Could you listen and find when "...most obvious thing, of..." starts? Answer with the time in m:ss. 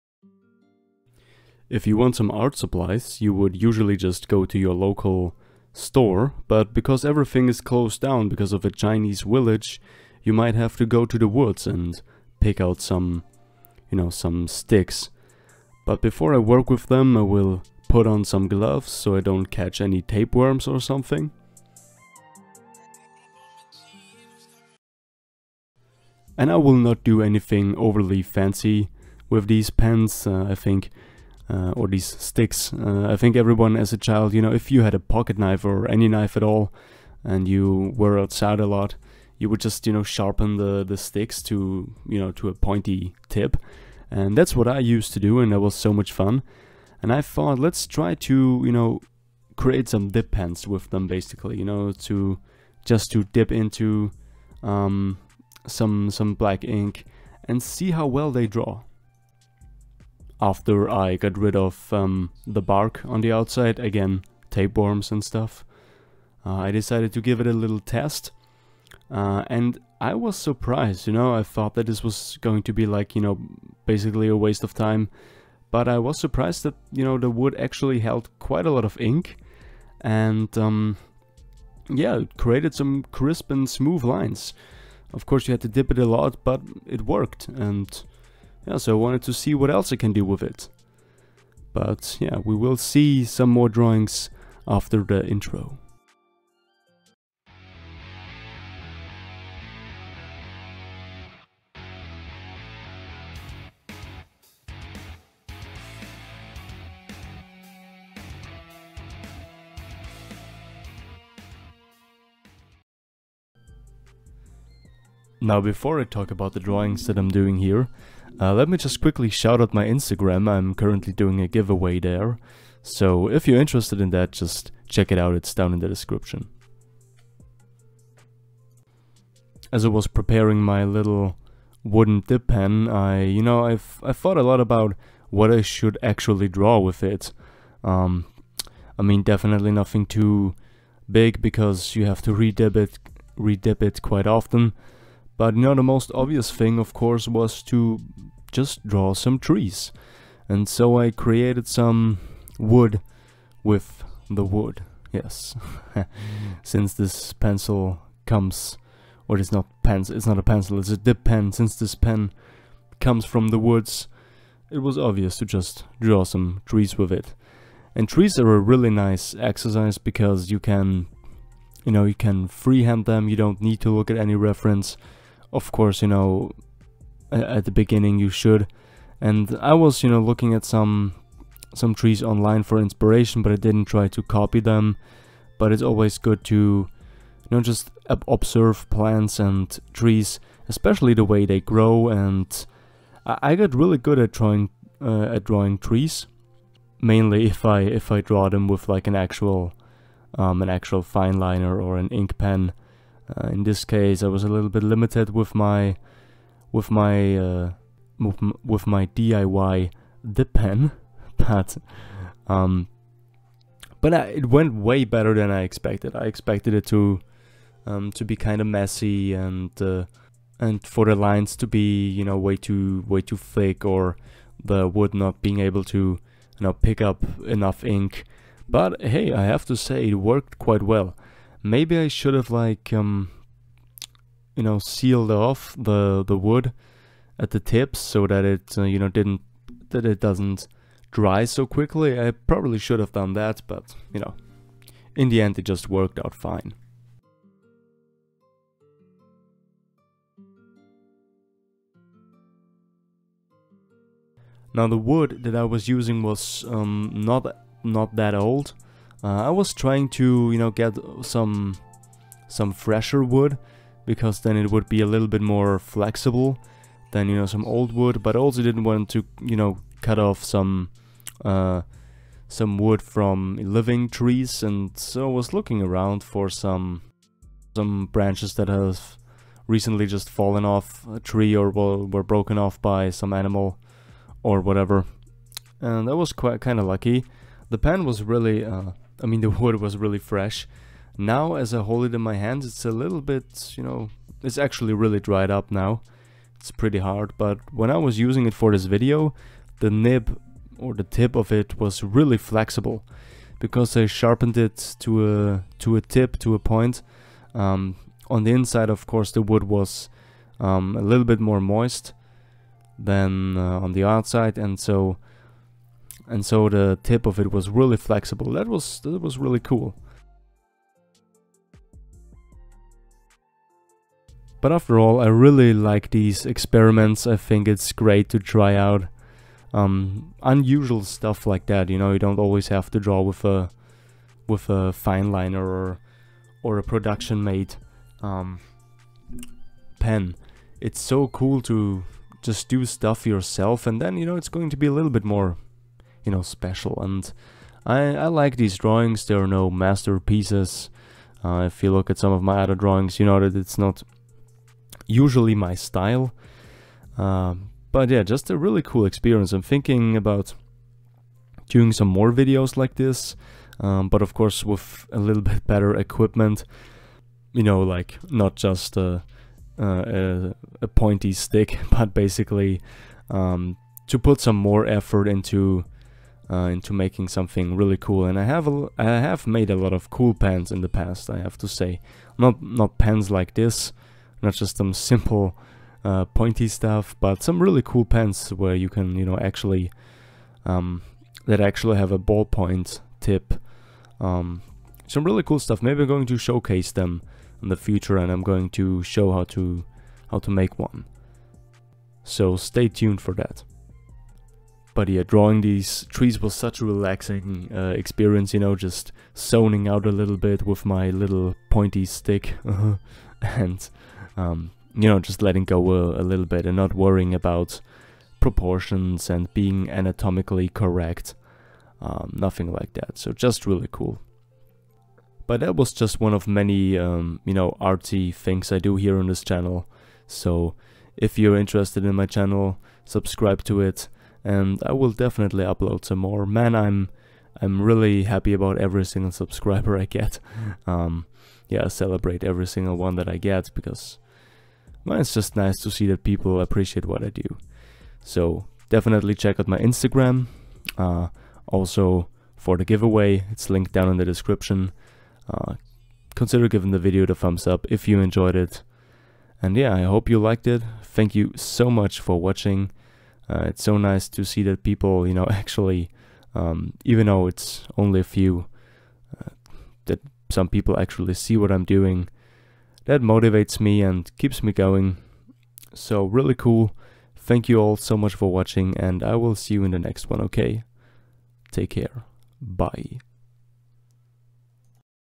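2:25.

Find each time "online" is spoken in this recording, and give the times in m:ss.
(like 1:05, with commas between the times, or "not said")
3:02.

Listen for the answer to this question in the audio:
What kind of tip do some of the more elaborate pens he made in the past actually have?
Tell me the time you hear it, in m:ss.
6:32.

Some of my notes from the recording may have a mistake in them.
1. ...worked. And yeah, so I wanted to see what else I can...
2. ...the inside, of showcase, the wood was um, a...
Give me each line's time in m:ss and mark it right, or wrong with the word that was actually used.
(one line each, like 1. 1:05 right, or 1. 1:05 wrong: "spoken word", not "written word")
1. 1:27 right
2. 5:08 wrong: "course", not "showcase".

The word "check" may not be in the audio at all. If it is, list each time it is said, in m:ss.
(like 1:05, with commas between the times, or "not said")
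2:04, 7:29.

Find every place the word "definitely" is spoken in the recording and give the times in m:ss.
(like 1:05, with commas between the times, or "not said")
2:19, 7:15, 7:28.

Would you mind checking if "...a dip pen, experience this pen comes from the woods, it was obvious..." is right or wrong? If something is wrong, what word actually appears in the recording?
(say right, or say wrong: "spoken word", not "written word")
wrong: "since", not "experience".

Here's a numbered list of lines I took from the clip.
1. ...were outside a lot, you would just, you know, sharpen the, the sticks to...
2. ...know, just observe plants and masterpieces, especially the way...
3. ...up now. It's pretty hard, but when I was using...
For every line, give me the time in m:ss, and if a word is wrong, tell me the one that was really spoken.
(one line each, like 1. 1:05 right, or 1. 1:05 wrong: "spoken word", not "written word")
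1. 0:37 right
2. 3:07 wrong: "trees", not "masterpieces"
3. 4:55 right.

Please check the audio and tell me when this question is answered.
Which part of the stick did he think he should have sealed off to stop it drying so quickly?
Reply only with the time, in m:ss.
3:57.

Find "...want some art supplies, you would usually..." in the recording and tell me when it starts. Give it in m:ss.
0:01.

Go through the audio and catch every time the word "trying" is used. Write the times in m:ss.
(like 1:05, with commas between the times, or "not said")
4:19.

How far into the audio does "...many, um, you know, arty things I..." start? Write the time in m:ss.
7:06.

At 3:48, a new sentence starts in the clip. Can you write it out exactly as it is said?
But hey, I have to say it worked quite well.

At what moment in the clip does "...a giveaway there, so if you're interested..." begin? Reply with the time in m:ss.
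2:01.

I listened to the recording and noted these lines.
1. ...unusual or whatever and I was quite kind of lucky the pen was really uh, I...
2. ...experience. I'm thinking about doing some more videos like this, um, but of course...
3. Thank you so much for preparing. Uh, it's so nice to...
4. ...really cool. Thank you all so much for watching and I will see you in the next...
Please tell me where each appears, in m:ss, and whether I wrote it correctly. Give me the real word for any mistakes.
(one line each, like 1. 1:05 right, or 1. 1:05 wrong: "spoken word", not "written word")
1. 4:43 wrong: "animal", not "unusual"
2. 5:59 right
3. 7:41 wrong: "watching", not "preparing"
4. 7:56 right.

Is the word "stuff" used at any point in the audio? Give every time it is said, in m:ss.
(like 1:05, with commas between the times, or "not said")
1:05, 5:31, 5:42, 6:26, 6:35.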